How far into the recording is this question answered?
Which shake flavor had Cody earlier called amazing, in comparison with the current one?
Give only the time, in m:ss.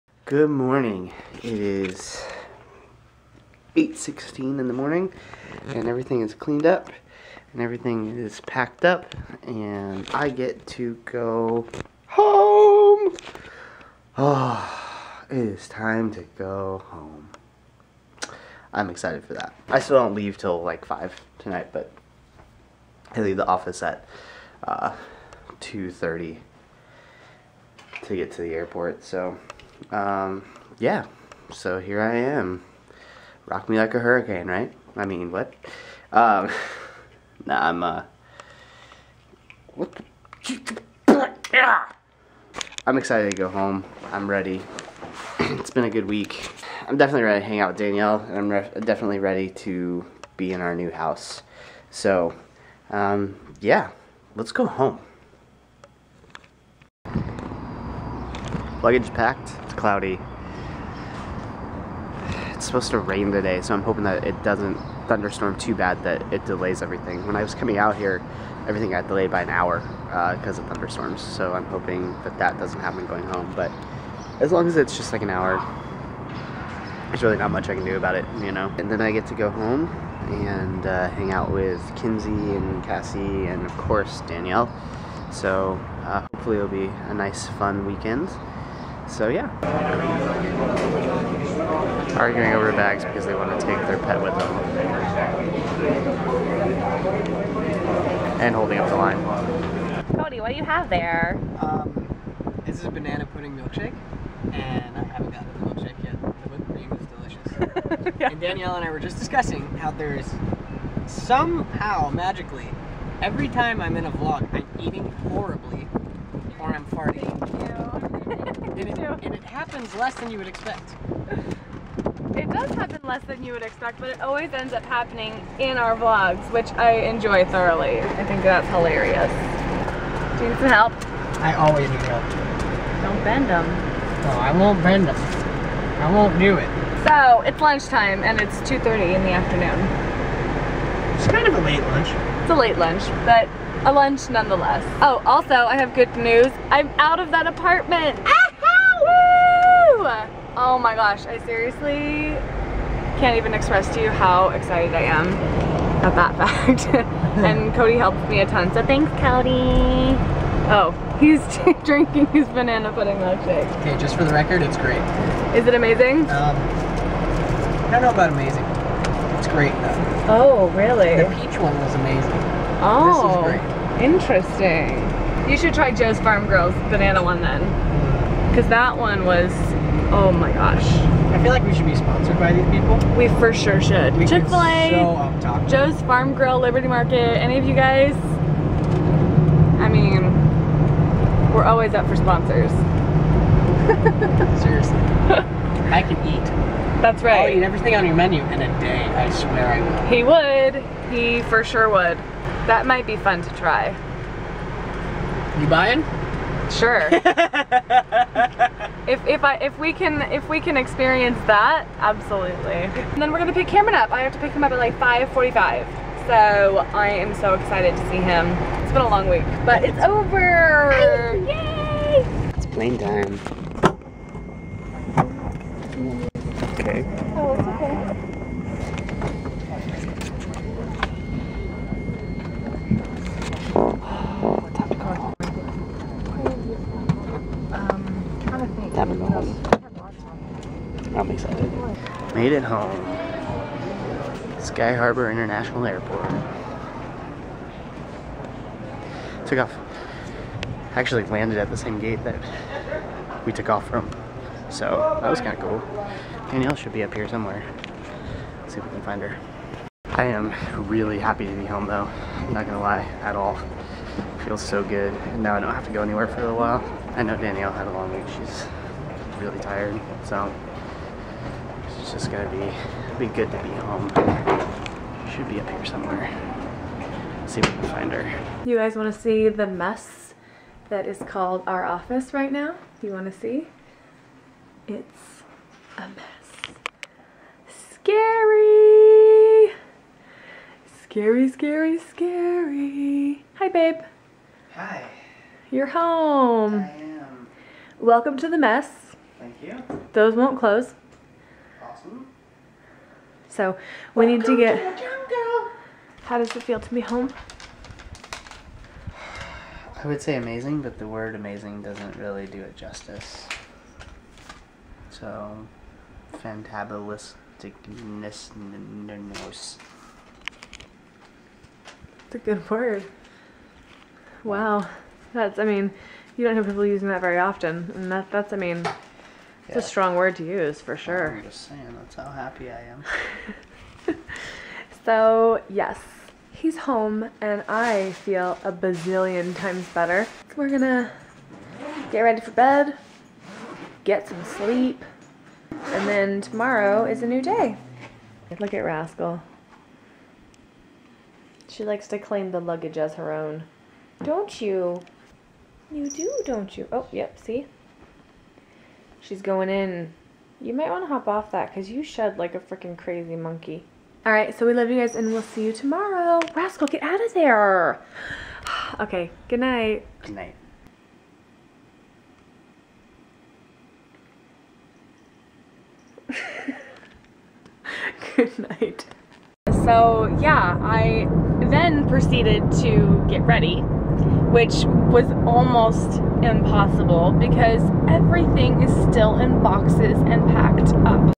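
2:51.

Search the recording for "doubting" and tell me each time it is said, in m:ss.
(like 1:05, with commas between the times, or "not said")
not said.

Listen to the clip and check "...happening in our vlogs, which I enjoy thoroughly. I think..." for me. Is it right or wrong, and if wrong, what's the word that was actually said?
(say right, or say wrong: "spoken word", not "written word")
right.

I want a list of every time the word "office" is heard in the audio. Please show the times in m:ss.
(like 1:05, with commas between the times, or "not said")
0:23, 4:41.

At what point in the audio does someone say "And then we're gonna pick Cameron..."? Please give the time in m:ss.
3:33.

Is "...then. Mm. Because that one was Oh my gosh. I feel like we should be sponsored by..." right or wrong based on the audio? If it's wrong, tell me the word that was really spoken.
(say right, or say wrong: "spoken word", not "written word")
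right.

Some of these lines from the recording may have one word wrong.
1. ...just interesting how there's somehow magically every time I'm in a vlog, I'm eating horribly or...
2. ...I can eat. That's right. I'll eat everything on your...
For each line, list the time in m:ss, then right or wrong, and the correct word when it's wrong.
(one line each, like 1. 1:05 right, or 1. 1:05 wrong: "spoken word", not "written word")
1. 1:48 wrong: "discussing", not "interesting"
2. 3:15 right.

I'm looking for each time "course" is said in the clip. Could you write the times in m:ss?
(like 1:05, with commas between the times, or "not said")
1:23.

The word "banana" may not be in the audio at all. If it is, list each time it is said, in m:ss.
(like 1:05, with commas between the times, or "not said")
1:42, 2:42, 2:56.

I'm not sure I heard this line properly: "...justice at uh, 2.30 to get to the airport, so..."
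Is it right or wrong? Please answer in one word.
wrong.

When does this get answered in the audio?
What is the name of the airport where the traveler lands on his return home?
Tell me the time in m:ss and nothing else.
4:04.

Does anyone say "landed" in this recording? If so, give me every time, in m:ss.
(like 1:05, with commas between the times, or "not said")
4:11.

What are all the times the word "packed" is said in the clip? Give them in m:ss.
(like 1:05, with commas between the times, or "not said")
0:08, 0:59, 6:30.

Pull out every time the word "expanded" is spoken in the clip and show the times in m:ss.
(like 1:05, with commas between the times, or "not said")
not said.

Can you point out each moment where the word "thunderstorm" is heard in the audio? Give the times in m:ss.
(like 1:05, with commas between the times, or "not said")
1:05, 1:10.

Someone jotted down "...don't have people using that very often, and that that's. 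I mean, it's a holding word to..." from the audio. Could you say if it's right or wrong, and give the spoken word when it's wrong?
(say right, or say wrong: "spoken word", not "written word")
wrong: "strong", not "holding".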